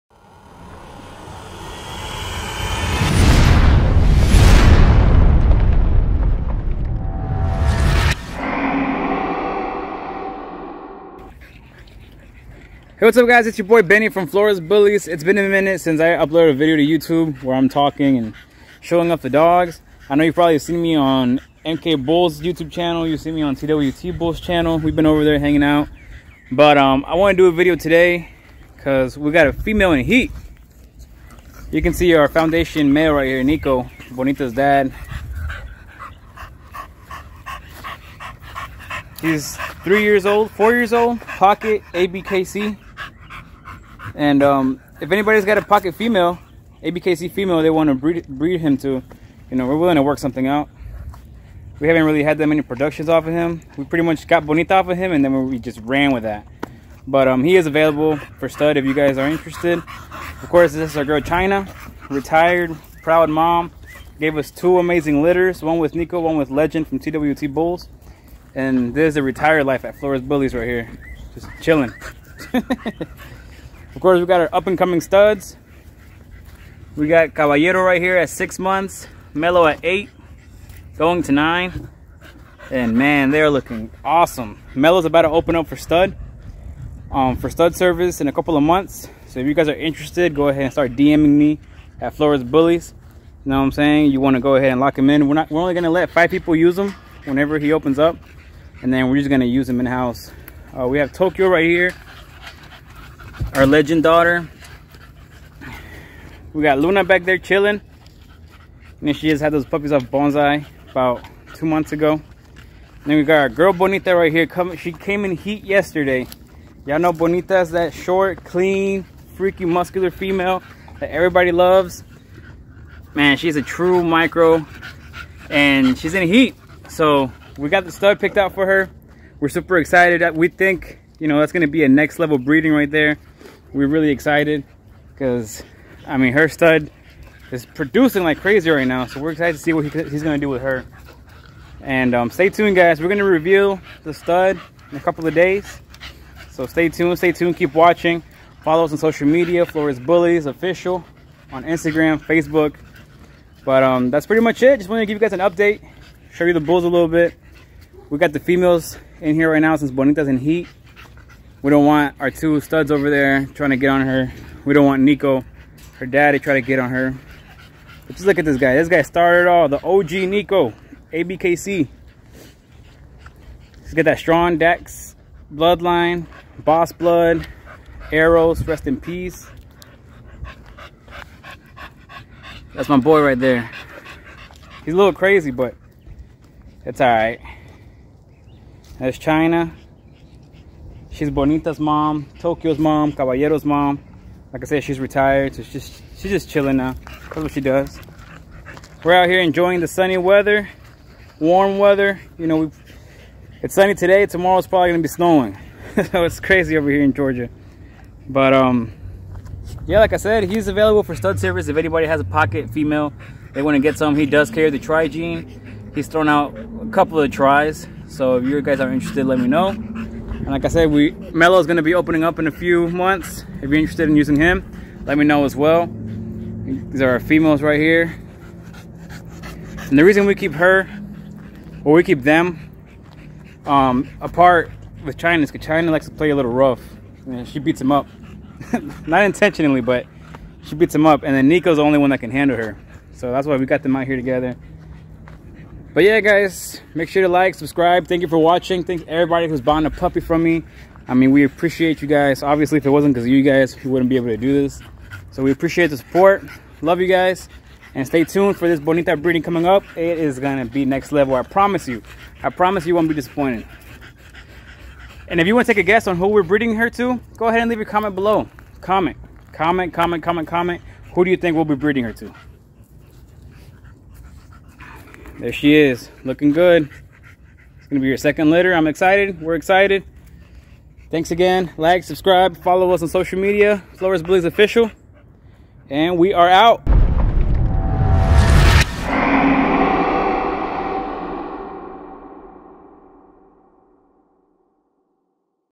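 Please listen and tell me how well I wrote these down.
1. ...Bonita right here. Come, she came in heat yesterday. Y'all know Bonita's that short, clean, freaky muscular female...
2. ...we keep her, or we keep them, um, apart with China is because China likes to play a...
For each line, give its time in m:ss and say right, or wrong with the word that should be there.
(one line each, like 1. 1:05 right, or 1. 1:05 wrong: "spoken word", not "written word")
1. 1:53 right
2. 3:50 right.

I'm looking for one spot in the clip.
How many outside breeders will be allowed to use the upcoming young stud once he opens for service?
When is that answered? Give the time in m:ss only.
1:36.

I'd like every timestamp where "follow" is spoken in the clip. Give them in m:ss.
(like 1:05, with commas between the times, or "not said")
2:28, 4:42.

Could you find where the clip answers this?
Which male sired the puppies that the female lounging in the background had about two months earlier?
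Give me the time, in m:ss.
1:50.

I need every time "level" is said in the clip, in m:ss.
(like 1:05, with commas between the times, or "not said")
2:12, 4:21.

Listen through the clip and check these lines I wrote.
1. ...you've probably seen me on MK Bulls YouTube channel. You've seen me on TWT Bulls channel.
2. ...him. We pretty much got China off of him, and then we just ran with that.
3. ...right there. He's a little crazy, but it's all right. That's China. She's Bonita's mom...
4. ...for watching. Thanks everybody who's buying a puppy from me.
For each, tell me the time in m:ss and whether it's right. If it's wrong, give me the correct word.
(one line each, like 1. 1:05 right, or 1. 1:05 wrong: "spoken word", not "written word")
1. 0:20 right
2. 0:53 wrong: "Bonita", not "China"
3. 3:03 right
4. 4:08 right.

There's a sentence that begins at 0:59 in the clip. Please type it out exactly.
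Of course, this is our girl China, retired, proud mom.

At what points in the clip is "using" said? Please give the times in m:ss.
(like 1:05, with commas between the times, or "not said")
3:44.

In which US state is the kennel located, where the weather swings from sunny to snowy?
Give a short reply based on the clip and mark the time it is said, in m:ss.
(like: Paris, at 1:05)
Georgia, at 3:27.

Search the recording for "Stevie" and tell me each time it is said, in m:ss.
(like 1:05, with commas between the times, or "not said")
not said.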